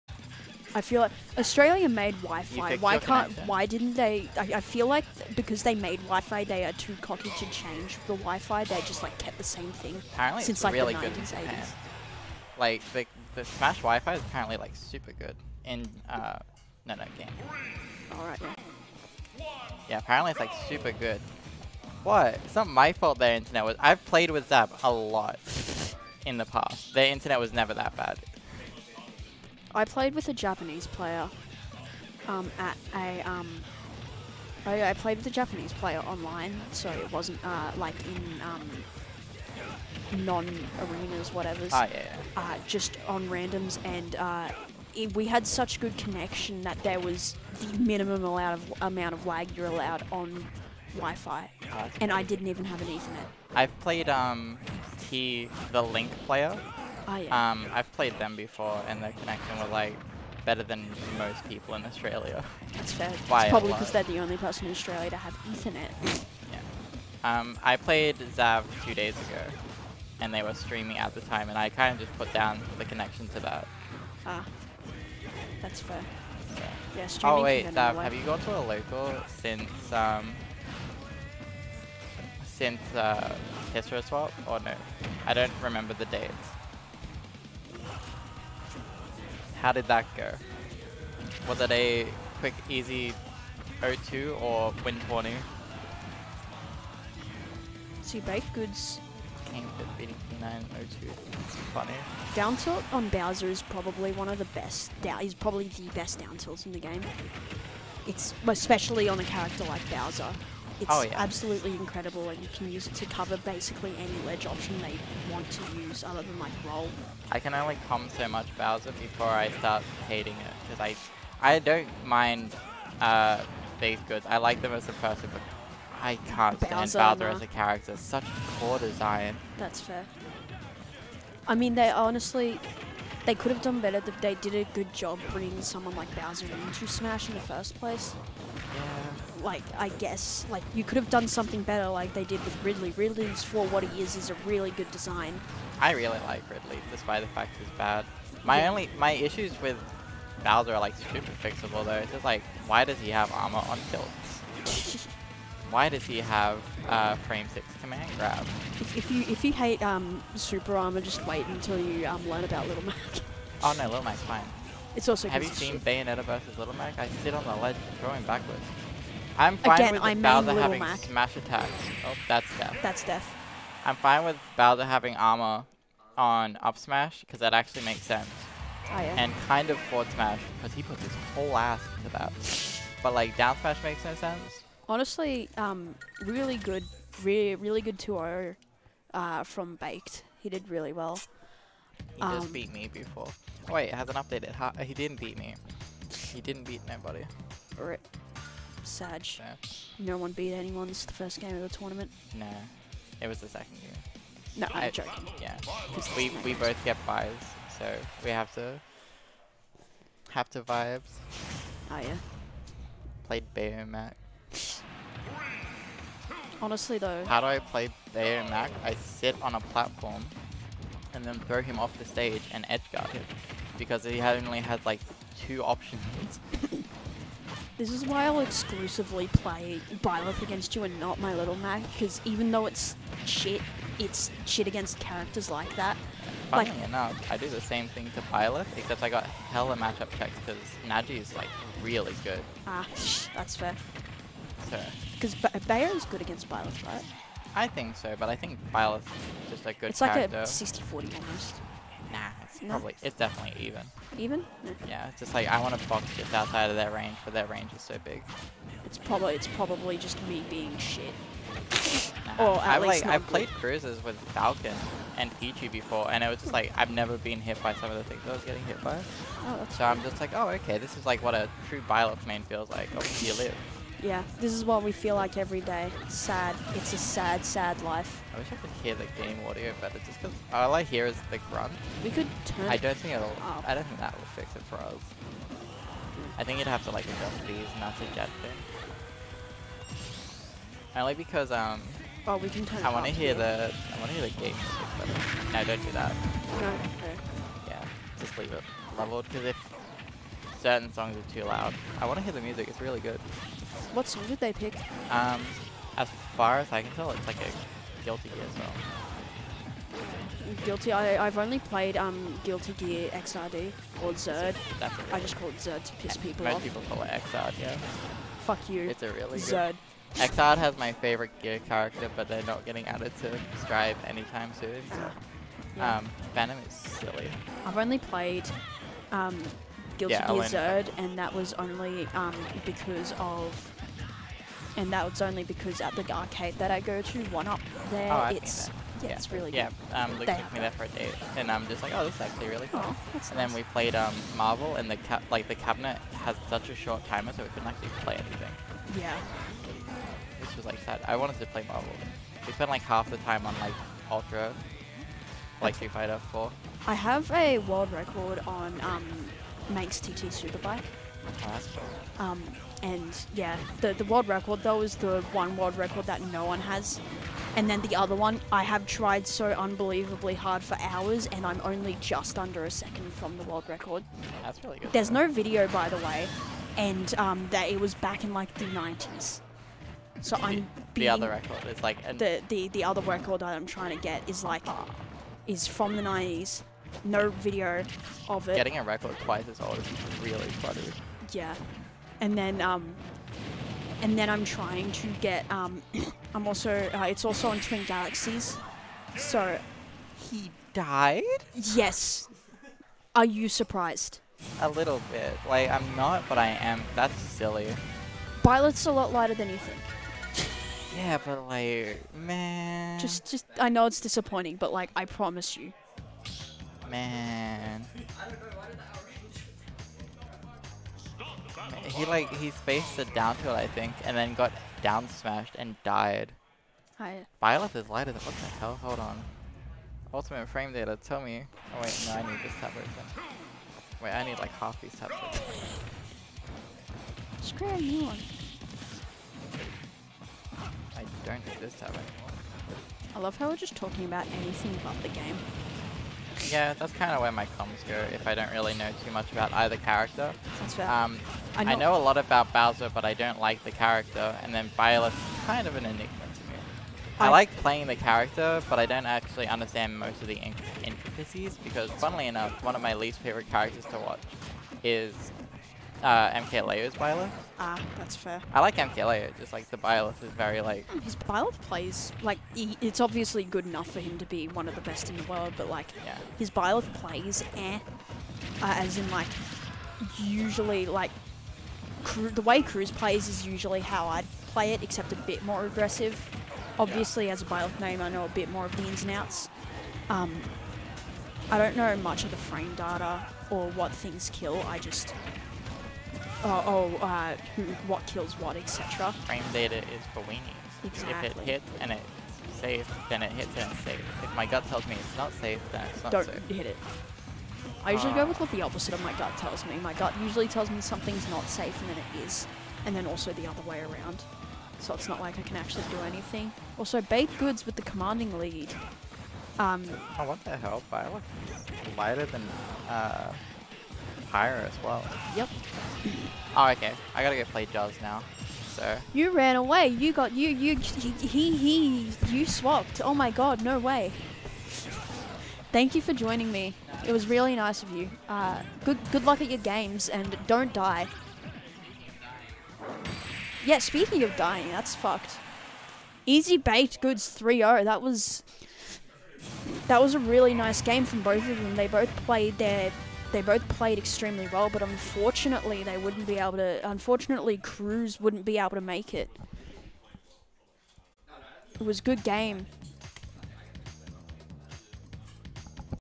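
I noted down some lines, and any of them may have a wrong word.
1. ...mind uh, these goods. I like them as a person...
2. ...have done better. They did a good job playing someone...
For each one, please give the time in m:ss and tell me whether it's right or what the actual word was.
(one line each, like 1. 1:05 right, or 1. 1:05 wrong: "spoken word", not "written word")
1. 2:02 right
2. 2:13 wrong: "bringing", not "playing".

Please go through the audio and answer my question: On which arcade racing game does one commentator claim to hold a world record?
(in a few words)
Manx TT Superbike.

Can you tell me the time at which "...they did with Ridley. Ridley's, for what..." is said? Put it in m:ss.
2:22.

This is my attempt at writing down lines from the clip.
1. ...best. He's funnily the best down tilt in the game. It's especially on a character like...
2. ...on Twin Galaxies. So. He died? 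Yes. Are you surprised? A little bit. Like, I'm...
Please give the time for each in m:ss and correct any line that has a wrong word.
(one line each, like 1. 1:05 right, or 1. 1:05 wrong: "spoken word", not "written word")
1. 1:44 wrong: "probably", not "funnily"
2. 6:37 right.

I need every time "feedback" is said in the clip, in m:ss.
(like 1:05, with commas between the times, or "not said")
not said.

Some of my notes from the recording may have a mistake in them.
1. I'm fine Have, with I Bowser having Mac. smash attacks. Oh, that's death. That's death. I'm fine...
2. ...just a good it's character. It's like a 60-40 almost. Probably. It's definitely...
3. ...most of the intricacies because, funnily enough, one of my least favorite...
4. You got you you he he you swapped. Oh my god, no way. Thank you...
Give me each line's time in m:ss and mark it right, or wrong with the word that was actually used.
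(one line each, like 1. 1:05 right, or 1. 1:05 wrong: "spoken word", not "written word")
1. 2:49 wrong: "Again", not "Have"
2. 4:09 right
3. 7:39 right
4. 8:49 right.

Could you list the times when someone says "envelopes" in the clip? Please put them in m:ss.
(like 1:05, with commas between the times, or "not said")
not said.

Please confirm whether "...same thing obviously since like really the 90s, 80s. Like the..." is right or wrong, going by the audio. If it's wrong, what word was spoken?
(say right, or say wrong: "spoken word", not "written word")
wrong: "apparently", not "obviously".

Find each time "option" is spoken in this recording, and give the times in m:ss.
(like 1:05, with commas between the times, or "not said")
1:54, 3:45.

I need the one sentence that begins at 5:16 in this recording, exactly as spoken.
Most people call it XRD, yeah.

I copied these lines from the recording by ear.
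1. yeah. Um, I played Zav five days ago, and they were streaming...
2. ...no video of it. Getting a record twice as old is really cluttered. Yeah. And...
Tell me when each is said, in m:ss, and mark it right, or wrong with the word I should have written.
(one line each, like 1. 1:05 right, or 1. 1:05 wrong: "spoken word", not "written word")
1. 1:06 wrong: "two", not "five"
2. 6:27 right.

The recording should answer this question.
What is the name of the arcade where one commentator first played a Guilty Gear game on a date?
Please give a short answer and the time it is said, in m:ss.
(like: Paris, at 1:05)
One Up, at 5:37.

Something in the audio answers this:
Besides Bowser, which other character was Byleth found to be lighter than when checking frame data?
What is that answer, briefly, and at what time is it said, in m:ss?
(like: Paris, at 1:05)
Pyra, at 8:44.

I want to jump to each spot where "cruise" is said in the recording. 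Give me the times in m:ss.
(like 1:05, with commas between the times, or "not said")
4:23, 8:02, 9:17.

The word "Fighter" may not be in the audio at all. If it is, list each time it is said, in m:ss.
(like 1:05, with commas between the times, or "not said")
5:55.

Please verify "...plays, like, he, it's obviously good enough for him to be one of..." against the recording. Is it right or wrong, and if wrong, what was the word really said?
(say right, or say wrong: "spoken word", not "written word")
right.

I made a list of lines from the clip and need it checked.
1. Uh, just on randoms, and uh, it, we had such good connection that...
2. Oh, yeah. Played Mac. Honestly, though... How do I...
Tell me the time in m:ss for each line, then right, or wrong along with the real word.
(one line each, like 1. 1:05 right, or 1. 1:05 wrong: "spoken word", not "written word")
1. 0:42 right
2. 3:31 right.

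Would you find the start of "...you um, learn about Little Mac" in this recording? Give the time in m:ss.
2:41.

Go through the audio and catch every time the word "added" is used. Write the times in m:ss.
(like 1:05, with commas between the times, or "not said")
5:22.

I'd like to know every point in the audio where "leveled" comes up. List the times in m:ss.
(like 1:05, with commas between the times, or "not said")
4:58.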